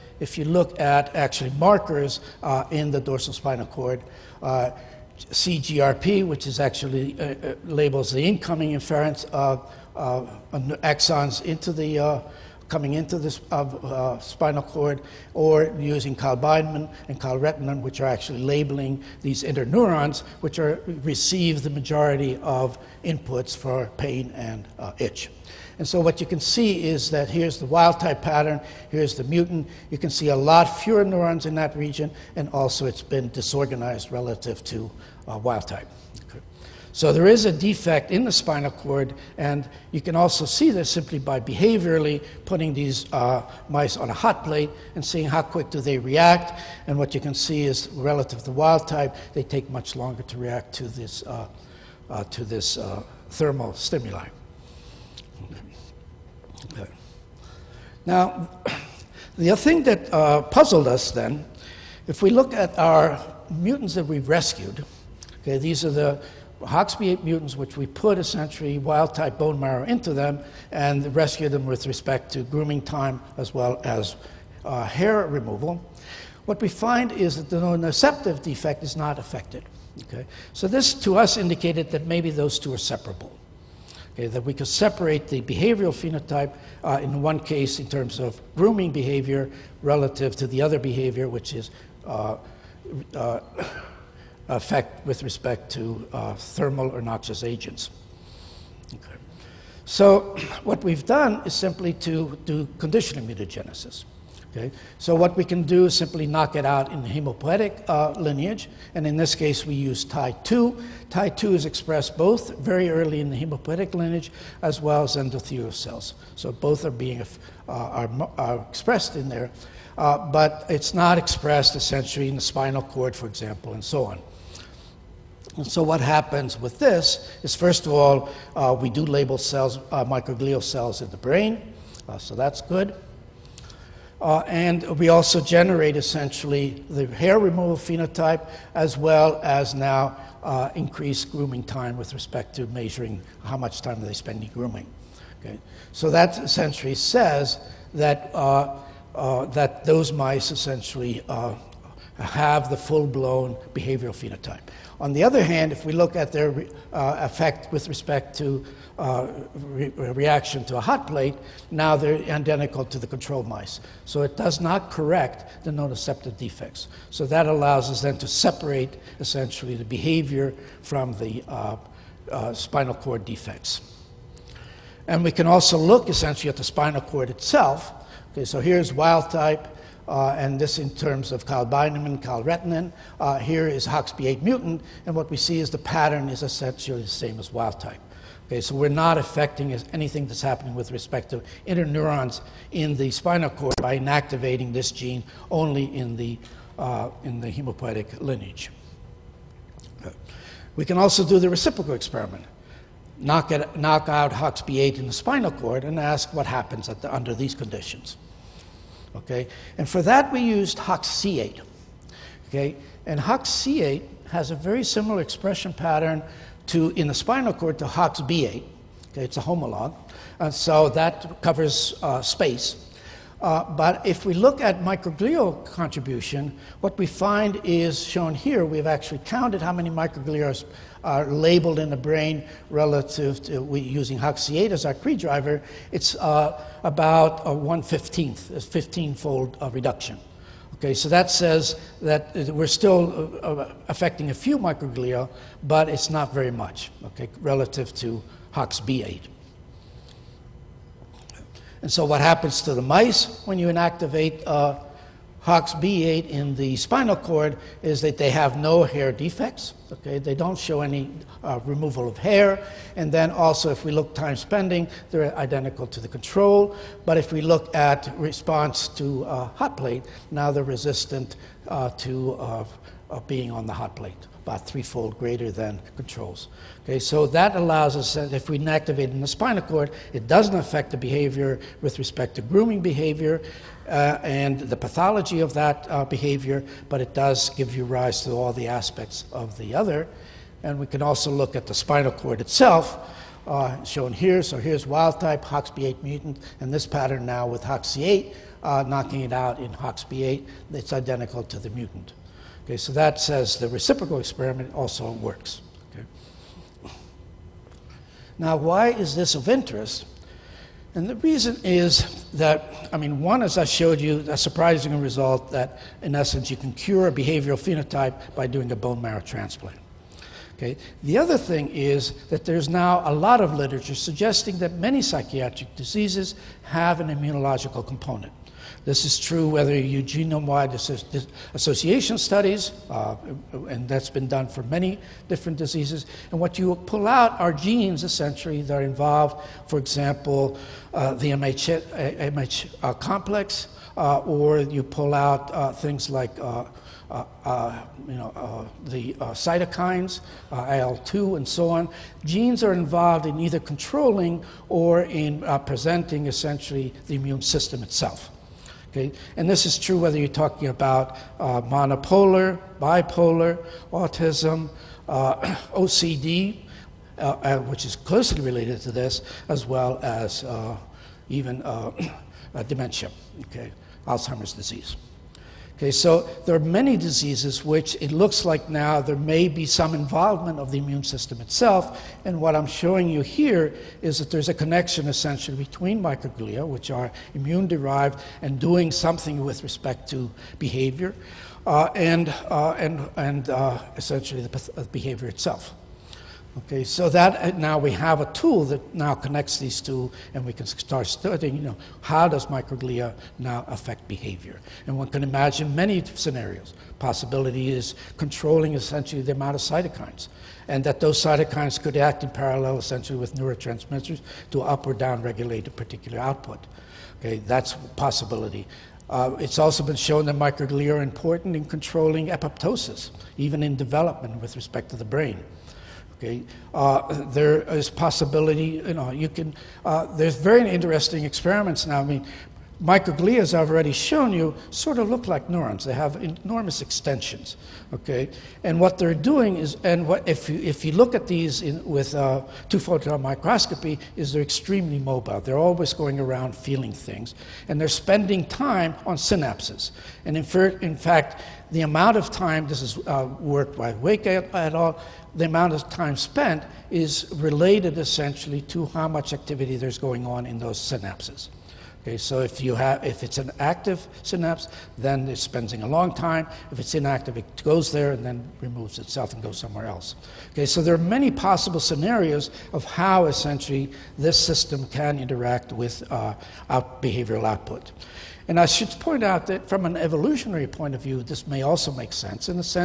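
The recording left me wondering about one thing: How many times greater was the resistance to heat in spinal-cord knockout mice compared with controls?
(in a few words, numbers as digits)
Threefold.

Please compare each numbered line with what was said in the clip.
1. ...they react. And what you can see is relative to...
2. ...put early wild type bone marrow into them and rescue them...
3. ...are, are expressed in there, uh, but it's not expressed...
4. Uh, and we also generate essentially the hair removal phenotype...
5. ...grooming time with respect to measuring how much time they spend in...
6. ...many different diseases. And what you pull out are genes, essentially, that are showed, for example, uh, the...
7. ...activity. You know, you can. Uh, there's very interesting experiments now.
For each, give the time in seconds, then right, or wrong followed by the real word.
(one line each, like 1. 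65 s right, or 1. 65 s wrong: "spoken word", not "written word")
1. 45 s right
2. 67 s wrong: "essentially", not "early"
3. 117 s right
4. 134 s right
5. 141 s right
6. 334 s wrong: "involved", not "showed"
7. 427 s wrong: "possibility", not "activity".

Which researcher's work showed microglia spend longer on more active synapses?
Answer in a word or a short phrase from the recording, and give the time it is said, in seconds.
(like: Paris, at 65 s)
Wake, at 453 s.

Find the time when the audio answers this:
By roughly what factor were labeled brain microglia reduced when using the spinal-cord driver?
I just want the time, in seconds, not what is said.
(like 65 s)
238 s.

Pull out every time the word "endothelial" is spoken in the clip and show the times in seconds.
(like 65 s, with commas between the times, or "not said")
115 s.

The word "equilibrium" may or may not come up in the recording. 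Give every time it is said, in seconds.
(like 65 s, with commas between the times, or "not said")
not said.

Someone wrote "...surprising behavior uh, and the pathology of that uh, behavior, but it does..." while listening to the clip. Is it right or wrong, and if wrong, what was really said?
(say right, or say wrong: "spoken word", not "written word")
wrong: "grooming", not "surprising".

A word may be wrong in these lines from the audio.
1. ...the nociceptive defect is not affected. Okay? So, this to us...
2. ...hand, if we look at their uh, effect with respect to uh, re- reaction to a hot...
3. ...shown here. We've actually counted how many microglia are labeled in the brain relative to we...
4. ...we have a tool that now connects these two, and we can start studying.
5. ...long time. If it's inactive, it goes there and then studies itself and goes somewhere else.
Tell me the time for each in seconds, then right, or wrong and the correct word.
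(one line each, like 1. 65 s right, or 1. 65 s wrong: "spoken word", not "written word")
1. 77 s right
2. 155 s right
3. 228 s right
4. 397 s right
5. 465 s wrong: "removes", not "studies".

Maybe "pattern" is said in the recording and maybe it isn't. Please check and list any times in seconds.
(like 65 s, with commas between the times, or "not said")
28 s, 185 s, 215 s, 296 s.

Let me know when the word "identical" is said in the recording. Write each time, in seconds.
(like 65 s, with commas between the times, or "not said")
162 s, 265 s, 300 s.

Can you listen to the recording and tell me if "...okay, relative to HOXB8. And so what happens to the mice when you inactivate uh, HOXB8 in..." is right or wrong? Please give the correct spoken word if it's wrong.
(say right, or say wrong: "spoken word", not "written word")
right.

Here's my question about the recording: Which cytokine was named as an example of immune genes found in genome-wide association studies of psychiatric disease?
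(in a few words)
IL-2.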